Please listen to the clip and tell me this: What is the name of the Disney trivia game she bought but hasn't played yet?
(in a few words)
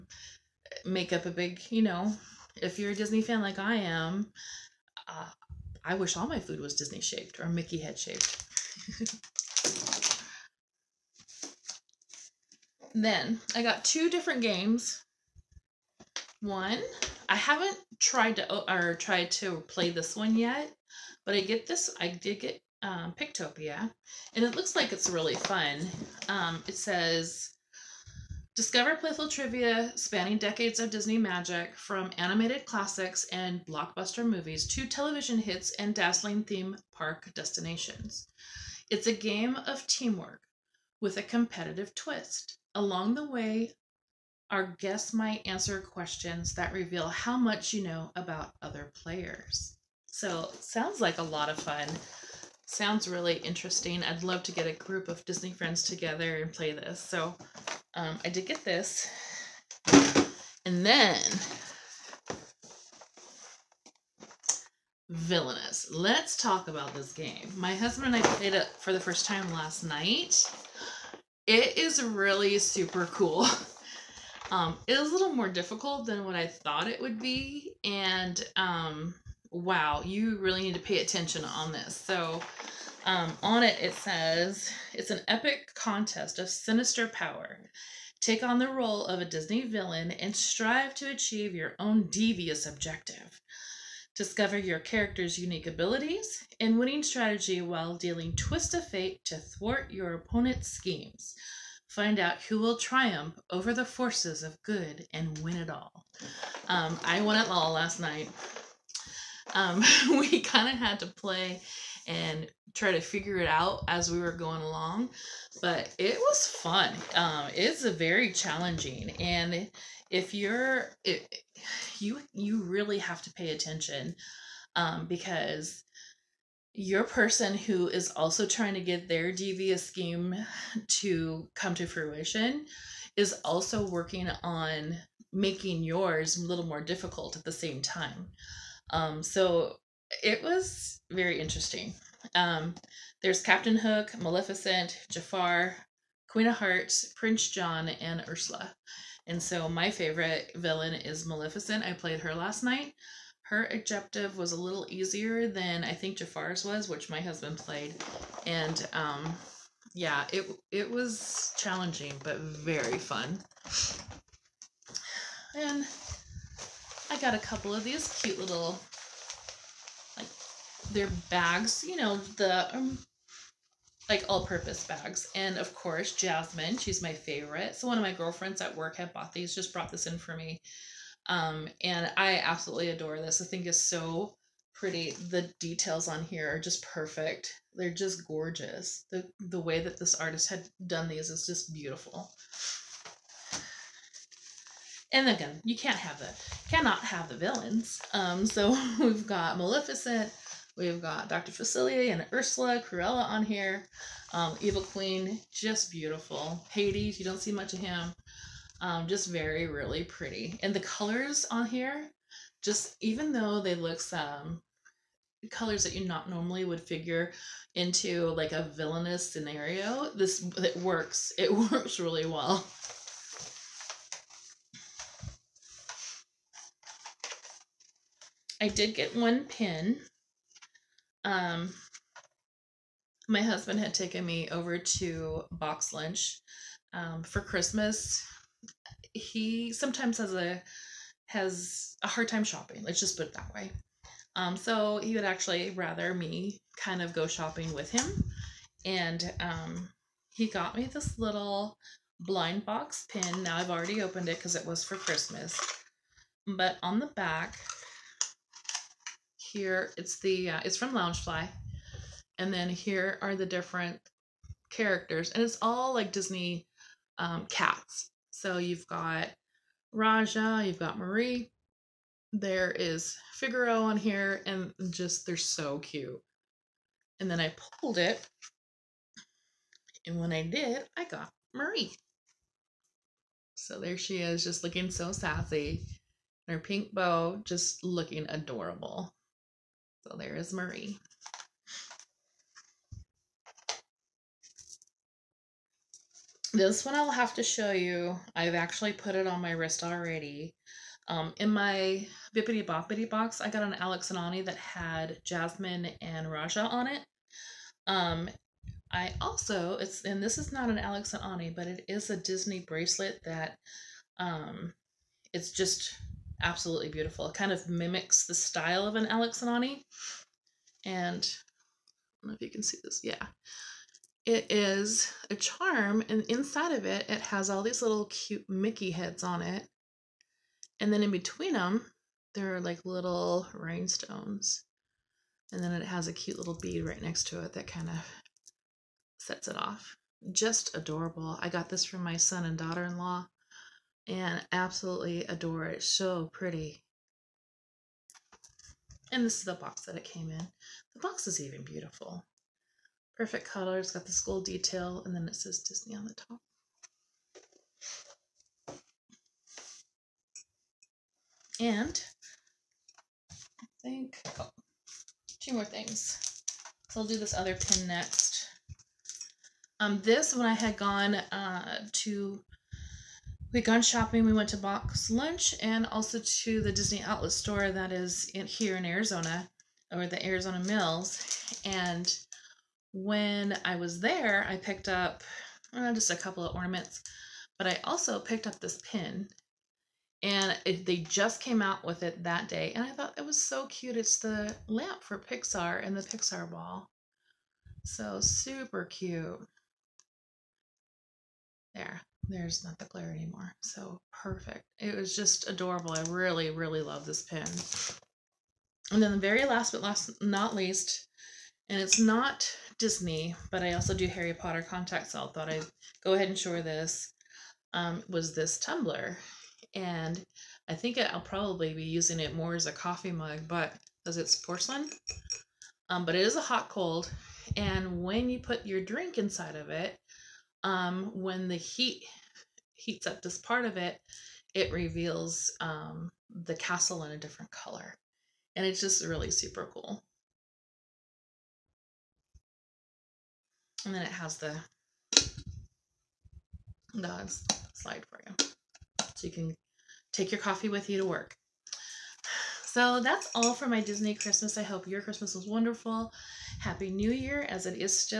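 Pictopia.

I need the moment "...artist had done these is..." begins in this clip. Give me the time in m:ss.
3:10.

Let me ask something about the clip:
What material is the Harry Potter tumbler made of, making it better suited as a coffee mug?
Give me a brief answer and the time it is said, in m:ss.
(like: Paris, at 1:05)
porcelain, at 7:04.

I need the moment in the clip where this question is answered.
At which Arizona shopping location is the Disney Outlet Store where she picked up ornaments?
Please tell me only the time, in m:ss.
6:20.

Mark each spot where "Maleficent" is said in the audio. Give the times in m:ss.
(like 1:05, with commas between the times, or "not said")
2:24, 2:31, 3:19.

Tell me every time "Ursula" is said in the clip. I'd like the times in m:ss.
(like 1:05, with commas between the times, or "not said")
2:28, 3:22.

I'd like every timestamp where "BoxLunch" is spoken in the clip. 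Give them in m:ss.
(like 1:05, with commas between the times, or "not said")
3:55, 6:14.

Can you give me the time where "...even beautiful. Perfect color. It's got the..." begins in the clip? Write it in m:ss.
5:51.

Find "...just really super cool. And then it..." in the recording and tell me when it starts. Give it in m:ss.
7:18.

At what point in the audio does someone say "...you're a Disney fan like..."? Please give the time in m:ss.
0:02.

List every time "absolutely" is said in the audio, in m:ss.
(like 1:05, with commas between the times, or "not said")
3:02, 5:16, 5:44.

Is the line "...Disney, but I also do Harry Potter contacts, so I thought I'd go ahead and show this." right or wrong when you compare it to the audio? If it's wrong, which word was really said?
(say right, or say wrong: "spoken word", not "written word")
right.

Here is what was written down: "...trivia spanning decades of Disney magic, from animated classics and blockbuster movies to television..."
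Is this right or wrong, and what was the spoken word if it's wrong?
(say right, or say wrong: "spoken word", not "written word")
right.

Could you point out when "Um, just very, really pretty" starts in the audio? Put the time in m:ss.
3:28.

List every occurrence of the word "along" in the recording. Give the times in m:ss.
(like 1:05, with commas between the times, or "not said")
0:42, 1:54.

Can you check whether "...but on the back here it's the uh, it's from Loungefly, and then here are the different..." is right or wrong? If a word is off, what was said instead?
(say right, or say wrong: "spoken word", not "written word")
right.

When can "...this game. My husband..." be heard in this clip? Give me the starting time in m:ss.
1:06.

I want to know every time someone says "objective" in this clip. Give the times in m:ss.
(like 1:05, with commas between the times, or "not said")
1:32, 2:33.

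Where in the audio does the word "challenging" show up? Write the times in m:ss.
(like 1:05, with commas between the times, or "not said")
1:58, 2:41.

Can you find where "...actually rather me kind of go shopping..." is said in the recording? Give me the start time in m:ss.
4:05.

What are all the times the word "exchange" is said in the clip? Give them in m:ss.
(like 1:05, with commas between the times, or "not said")
not said.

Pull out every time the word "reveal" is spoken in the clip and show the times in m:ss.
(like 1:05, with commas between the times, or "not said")
0:46, 7:14.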